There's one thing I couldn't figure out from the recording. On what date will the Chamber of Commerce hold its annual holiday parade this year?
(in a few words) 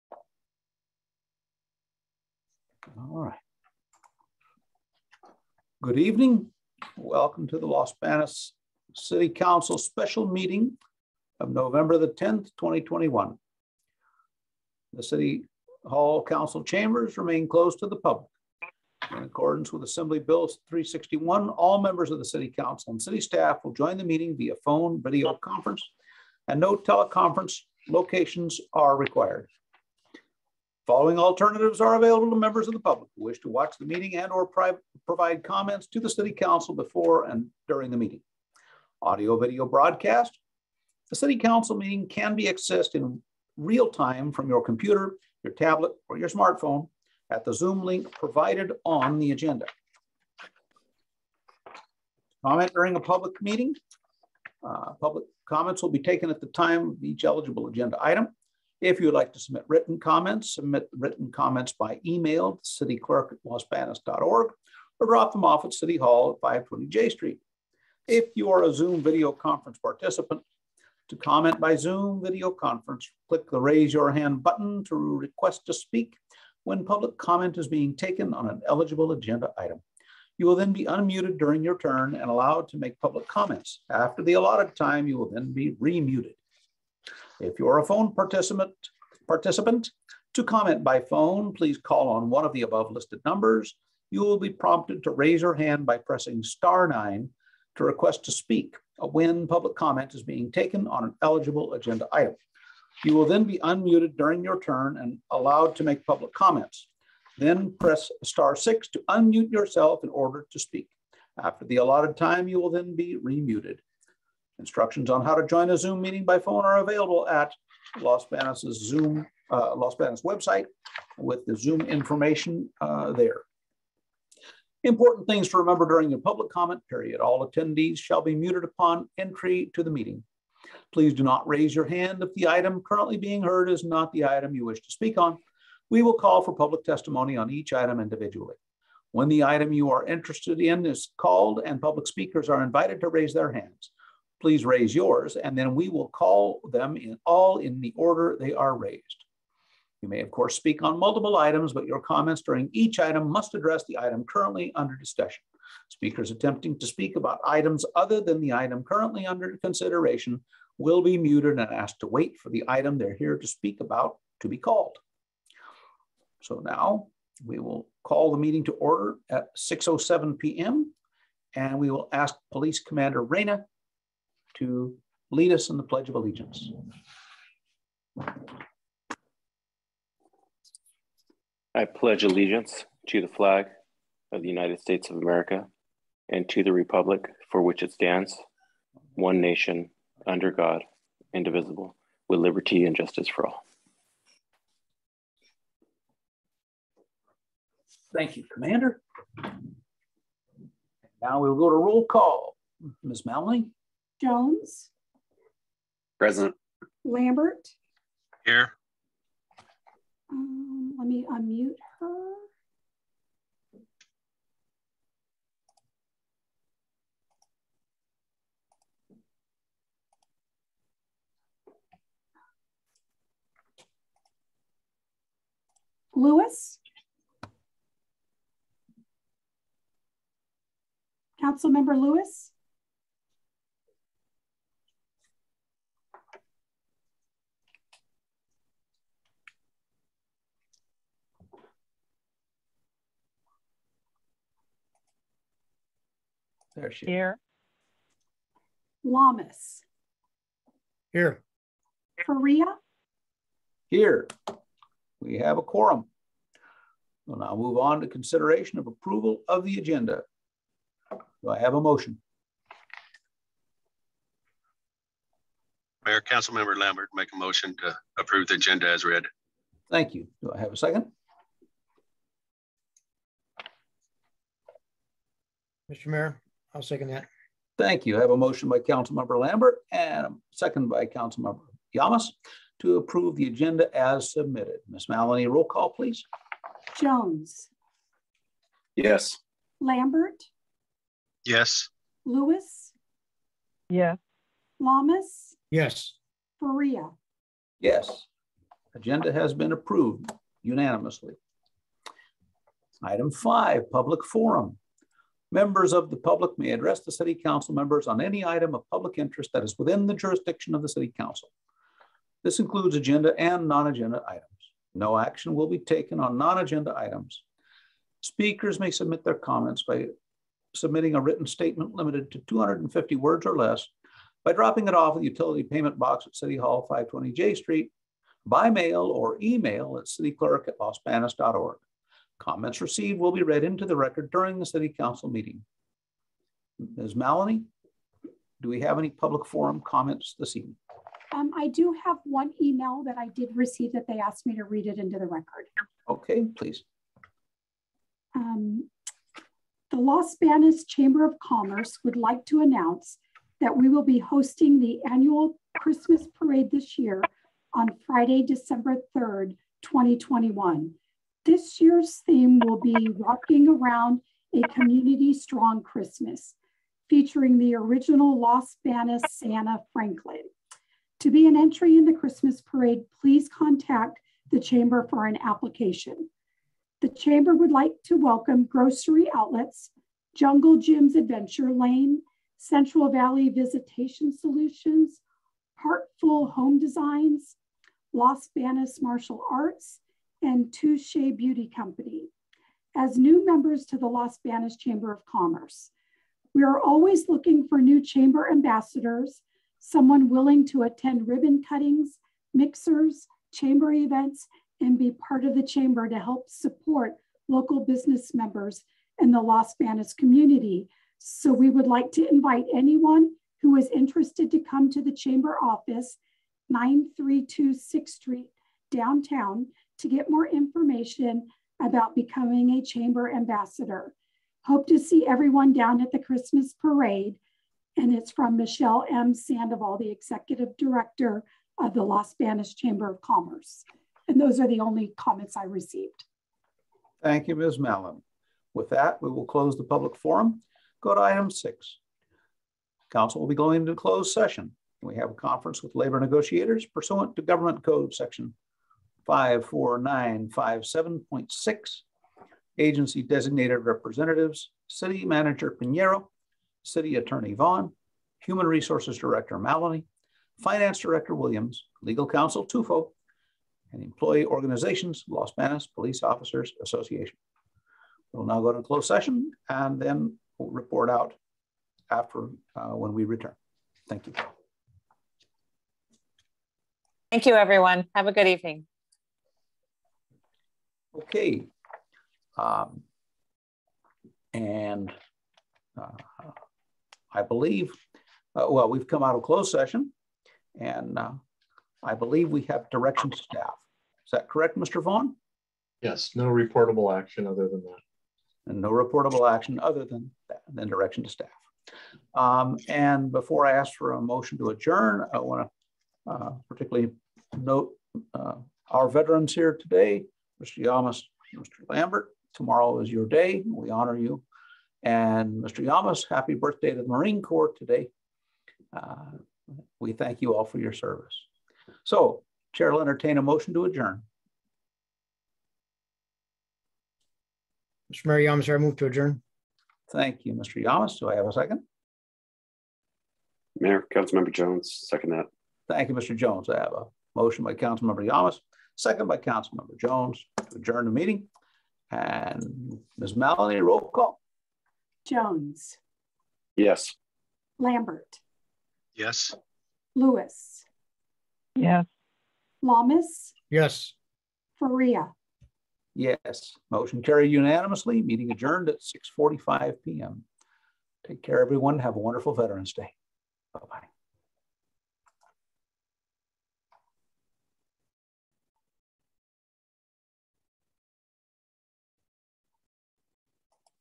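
Friday, December 3rd, 2021.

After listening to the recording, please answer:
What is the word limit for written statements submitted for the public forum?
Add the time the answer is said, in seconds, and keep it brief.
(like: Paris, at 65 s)
250 words, at 322 s.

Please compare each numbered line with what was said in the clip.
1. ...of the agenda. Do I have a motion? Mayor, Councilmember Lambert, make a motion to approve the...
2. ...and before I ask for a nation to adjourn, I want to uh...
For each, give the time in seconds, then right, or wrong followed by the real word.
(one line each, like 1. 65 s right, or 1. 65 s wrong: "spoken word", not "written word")
1. 259 s right
2. 502 s wrong: "motion", not "nation".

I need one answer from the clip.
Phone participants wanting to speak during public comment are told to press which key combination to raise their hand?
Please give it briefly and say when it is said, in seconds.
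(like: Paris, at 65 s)
star nine, at 96 s.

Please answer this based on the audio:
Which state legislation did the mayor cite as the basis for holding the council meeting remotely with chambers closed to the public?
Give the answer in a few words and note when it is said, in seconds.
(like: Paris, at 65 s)
Assembly Bill 361, at 19 s.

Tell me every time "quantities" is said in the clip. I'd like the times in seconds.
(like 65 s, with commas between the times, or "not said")
not said.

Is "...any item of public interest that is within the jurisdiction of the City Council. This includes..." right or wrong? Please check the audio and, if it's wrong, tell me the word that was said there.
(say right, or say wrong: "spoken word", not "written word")
right.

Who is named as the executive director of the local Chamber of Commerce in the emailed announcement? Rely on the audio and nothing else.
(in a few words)
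Michelle M. Sandoval.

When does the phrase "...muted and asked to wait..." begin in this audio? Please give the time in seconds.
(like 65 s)
161 s.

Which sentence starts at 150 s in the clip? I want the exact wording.
You may, of course, speak on multiple items, but your comments during each item must address the item currently under discussion.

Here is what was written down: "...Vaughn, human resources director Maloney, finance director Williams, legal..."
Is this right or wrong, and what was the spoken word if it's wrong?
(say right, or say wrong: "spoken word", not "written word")
right.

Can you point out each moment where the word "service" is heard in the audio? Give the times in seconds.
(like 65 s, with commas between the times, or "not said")
520 s.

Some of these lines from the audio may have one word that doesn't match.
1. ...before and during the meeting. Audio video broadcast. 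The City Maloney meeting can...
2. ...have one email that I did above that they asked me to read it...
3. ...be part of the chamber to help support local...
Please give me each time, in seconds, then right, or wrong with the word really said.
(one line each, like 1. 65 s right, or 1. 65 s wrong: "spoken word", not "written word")
1. 36 s wrong: "Council", not "Maloney"
2. 342 s wrong: "receive", not "above"
3. 404 s right.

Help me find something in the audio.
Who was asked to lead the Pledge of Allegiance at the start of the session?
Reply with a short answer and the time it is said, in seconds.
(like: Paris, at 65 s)
Police Commander Reyna, at 172 s.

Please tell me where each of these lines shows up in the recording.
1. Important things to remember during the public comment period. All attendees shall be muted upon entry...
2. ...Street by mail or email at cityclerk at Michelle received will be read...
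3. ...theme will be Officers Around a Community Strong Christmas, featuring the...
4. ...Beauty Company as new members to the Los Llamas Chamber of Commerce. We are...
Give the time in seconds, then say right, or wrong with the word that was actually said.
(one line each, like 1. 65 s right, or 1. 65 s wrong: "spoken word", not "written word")
1. 124 s right
2. 327 s wrong: "Comments", not "Michelle"
3. 362 s wrong: "Rocking", not "Officers"
4. 391 s wrong: "Banos", not "Llamas".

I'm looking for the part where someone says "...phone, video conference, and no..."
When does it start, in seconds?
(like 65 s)
24 s.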